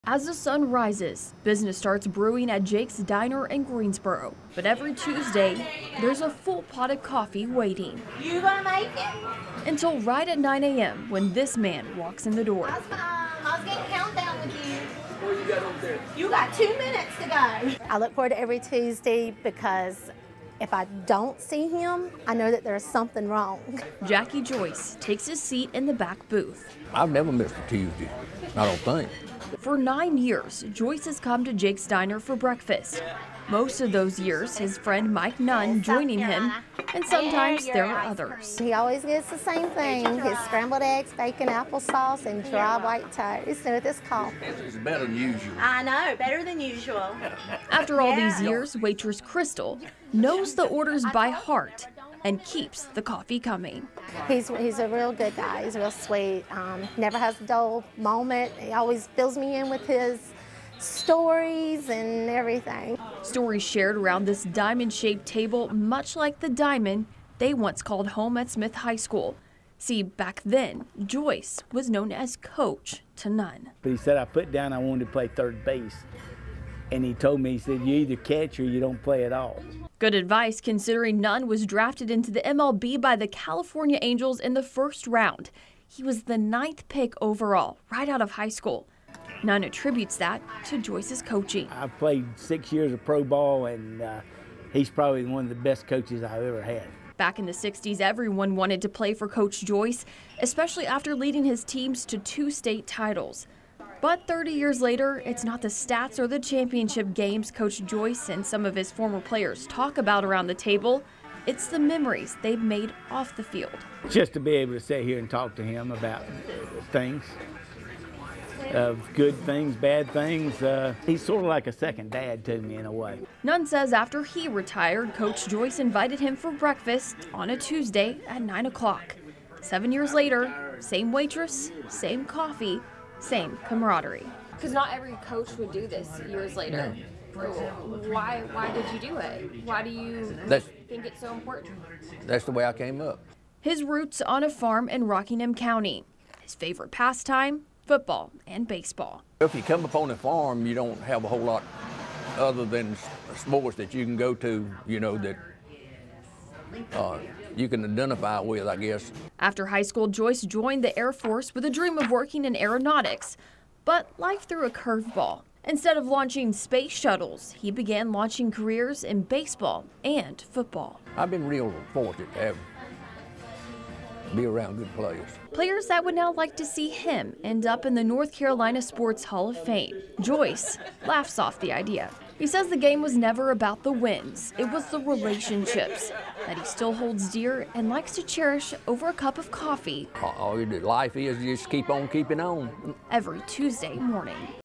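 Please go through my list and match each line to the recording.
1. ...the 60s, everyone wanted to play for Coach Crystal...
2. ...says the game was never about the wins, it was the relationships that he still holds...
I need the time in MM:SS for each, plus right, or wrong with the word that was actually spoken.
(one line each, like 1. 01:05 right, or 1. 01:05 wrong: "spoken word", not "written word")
1. 01:37 wrong: "Joyce", not "Crystal"
2. 03:02 right.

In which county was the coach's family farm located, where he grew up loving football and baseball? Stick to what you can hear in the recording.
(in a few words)
Rockingham County.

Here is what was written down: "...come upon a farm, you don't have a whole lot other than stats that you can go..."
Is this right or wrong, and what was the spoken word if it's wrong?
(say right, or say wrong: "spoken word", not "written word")
wrong: "sports", not "stats".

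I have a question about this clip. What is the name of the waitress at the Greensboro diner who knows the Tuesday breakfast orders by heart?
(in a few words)
Crystal.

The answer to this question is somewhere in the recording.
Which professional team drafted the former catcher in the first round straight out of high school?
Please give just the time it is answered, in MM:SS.
01:23.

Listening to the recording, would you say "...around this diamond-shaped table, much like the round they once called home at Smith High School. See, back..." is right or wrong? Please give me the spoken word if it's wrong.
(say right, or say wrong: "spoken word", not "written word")
wrong: "diamond", not "round".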